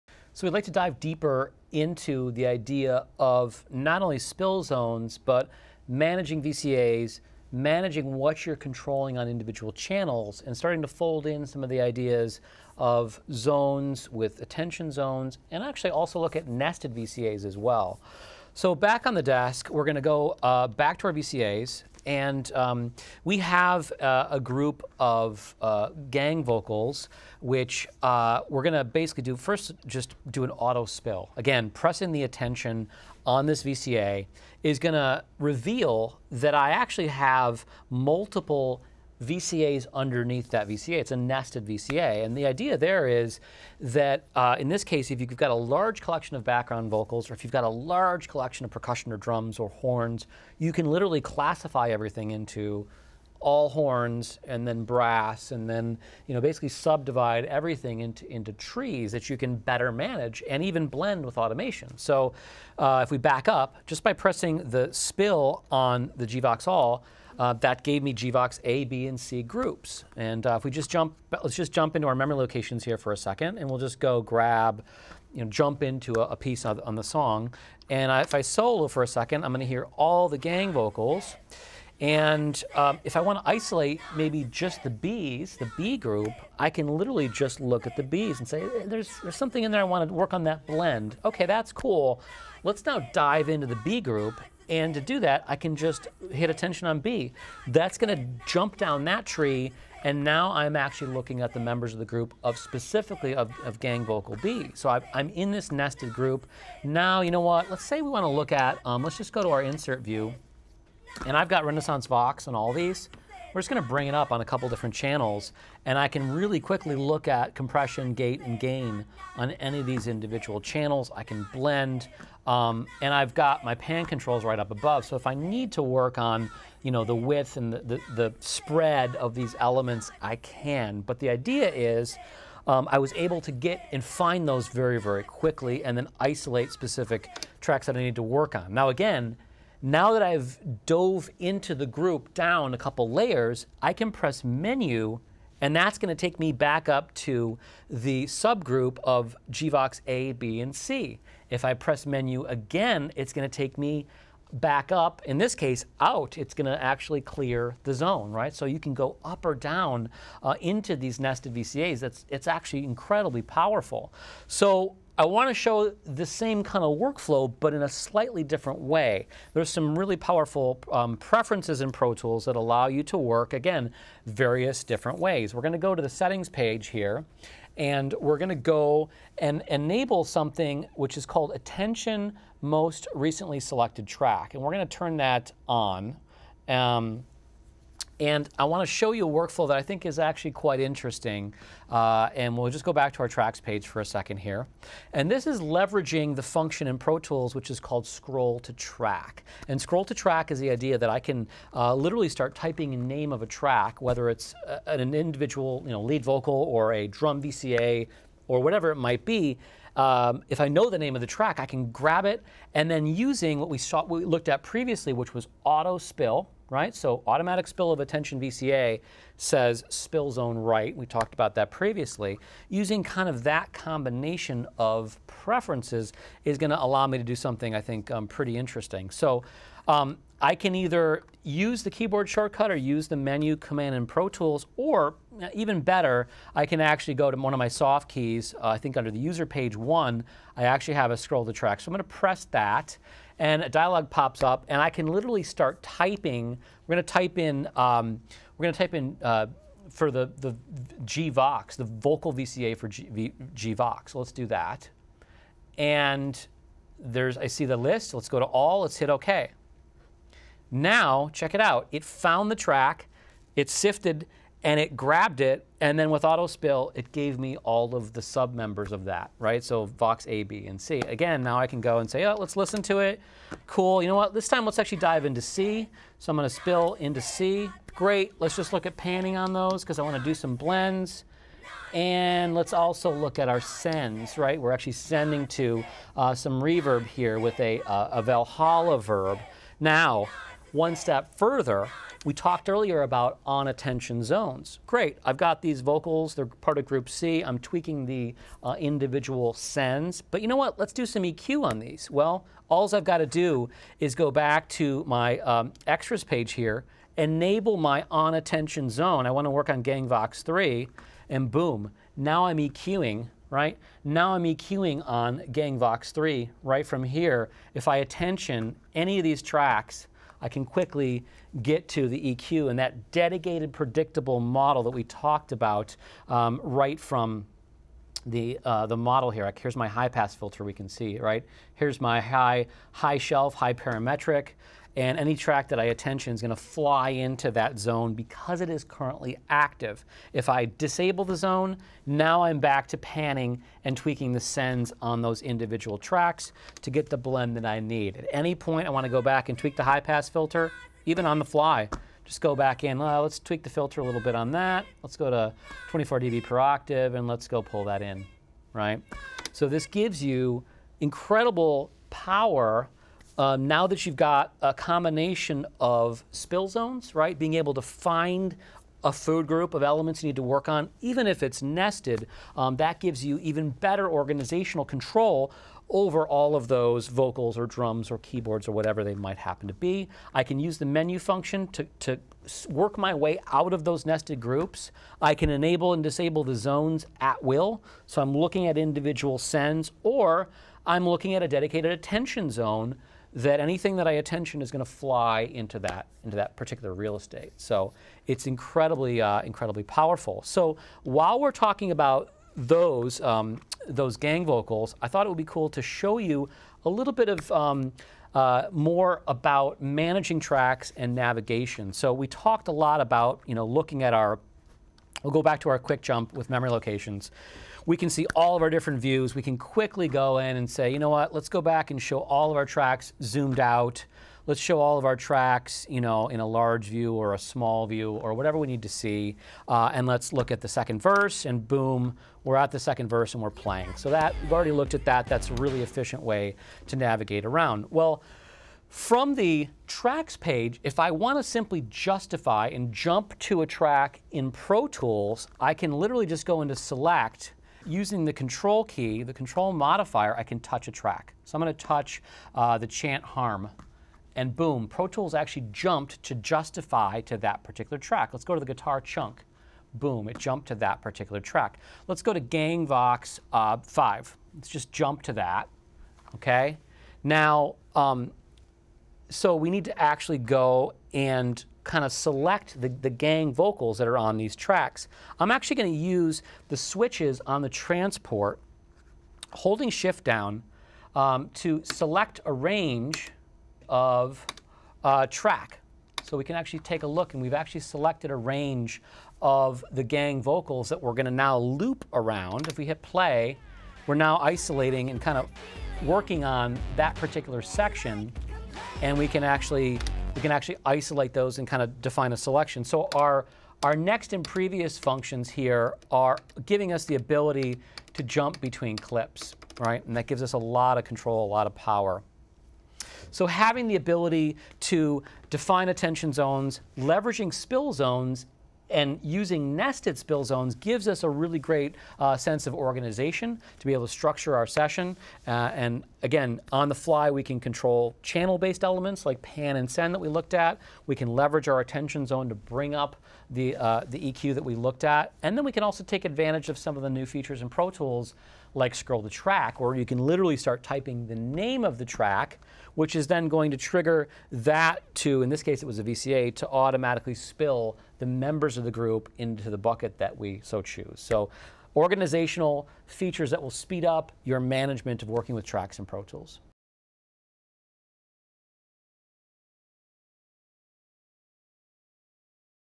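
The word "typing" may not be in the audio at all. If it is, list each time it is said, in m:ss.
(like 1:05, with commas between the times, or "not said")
3:22, 4:05, 9:00.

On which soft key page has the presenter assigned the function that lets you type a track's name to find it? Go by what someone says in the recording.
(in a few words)
User page one.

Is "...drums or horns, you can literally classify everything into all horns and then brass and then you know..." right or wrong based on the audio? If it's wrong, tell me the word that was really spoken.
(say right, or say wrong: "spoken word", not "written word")
right.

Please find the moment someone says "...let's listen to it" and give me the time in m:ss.
4:32.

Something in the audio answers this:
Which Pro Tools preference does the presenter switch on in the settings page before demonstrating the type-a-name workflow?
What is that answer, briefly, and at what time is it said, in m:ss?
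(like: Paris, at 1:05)
Attention most recently selected track, at 3:01.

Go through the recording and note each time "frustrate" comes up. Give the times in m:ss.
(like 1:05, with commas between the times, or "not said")
not said.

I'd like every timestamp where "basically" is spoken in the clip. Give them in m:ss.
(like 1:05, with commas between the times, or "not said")
0:28, 0:56.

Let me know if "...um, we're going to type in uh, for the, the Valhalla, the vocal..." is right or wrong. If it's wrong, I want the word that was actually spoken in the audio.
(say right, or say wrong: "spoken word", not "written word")
wrong: "GVox", not "Valhalla".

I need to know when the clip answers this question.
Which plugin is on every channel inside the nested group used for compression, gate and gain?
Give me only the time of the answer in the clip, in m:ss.
1:51.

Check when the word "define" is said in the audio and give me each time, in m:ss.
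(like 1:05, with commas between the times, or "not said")
8:22, 8:35.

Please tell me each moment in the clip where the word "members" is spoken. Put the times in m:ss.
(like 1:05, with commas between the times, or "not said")
1:41, 4:28, 9:08.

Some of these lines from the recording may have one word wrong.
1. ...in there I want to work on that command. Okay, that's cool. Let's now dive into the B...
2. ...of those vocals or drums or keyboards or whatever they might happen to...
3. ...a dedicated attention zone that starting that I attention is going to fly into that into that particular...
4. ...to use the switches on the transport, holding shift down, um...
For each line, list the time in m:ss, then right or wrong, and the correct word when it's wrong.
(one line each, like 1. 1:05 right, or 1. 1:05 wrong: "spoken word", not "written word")
1. 1:29 wrong: "blend", not "command"
2. 6:16 right
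3. 6:31 wrong: "anything", not "starting"
4. 7:55 right.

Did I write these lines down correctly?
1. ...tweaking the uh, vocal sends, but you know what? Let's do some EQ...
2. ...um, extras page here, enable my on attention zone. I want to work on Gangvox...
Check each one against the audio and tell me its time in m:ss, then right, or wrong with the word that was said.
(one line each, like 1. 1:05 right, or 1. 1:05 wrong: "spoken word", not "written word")
1. 4:57 wrong: "individual", not "vocal"
2. 5:05 right.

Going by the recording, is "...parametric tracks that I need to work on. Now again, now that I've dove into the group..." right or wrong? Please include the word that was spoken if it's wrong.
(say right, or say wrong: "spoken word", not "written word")
wrong: "specific", not "parametric".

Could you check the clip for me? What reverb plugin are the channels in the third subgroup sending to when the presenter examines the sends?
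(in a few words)
Valhalla verb.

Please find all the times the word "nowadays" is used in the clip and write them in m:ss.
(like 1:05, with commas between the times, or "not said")
not said.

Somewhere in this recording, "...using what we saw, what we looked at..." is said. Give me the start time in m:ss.
3:33.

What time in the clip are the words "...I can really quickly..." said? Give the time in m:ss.
1:55.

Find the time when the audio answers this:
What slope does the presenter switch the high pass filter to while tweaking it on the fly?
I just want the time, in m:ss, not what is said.
5:55.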